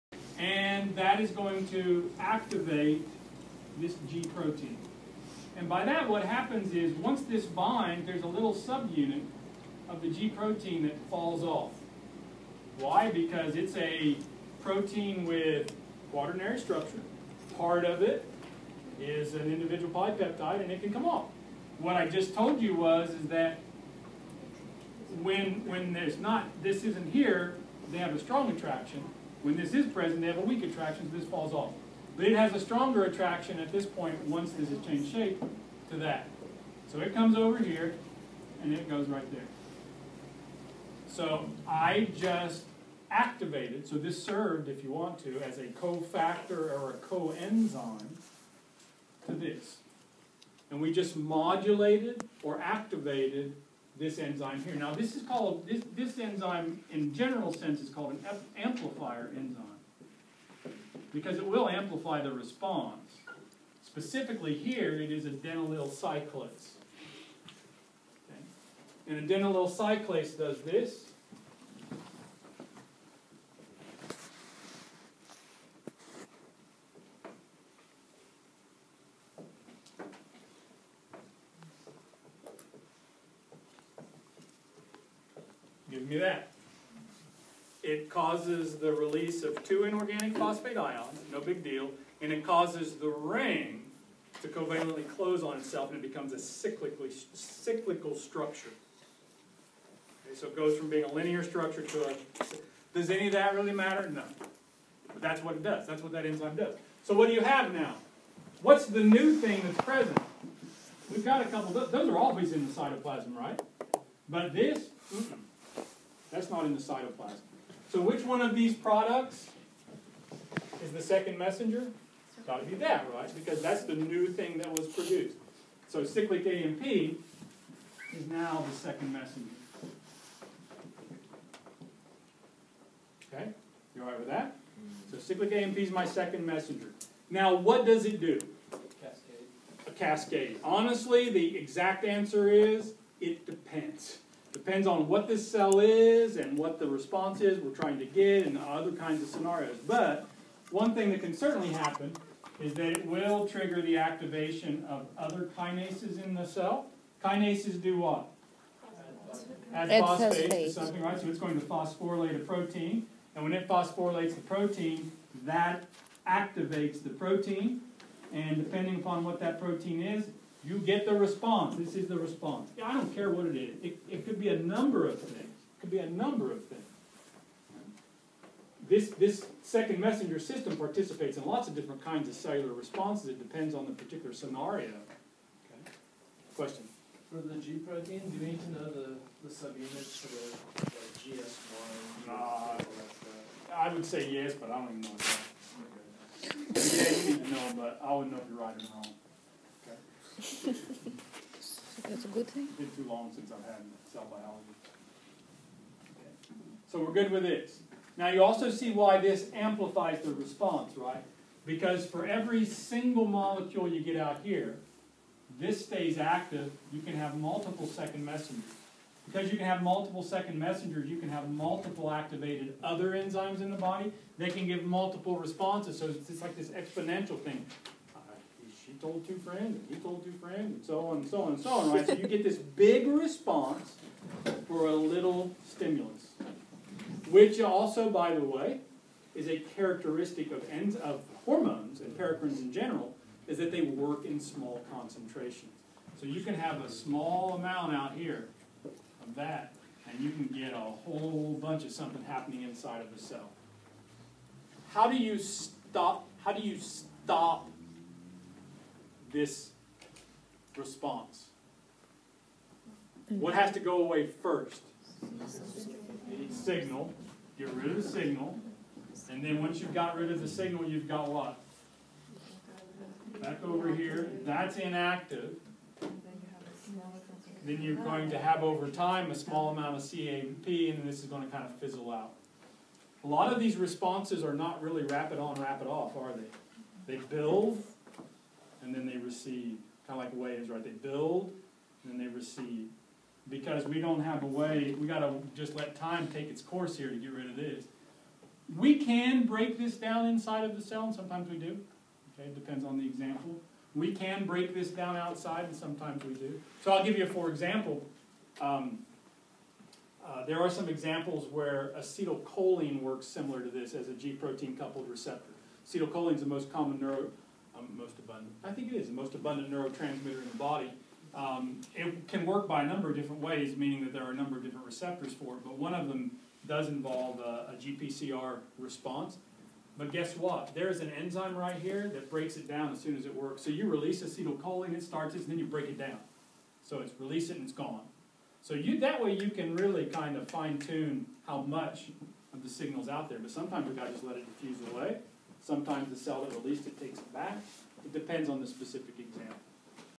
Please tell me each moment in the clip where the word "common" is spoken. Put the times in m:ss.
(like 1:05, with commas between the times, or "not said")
5:16.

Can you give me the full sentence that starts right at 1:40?
Okay, so it goes from being a linear structure to a.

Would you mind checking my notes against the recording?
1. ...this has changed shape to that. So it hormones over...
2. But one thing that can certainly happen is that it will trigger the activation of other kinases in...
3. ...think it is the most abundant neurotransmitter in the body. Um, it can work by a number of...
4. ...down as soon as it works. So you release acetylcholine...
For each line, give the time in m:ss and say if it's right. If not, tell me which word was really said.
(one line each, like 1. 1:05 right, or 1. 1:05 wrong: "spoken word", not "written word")
1. 0:34 wrong: "comes", not "hormones"
2. 2:29 right
3. 5:18 right
4. 5:32 right.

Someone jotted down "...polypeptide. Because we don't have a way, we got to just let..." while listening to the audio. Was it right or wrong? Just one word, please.
wrong.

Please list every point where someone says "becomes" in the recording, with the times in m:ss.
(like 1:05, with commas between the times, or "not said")
1:36.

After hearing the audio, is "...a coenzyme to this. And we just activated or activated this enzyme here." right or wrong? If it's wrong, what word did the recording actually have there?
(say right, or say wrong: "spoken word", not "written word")
wrong: "modulated", not "activated".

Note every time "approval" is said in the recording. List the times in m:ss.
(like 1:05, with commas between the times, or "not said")
not said.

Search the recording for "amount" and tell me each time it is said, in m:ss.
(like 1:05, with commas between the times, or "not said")
4:07, 4:39.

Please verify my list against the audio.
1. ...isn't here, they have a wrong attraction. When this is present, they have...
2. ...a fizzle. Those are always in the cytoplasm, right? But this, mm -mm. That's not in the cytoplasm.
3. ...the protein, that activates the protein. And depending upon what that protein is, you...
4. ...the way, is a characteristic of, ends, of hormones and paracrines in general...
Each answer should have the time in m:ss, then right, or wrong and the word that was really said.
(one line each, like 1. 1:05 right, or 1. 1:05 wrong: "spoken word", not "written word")
1. 0:26 wrong: "strong", not "wrong"
2. 1:51 wrong: "couple", not "fizzle"
3. 2:44 right
4. 3:58 right.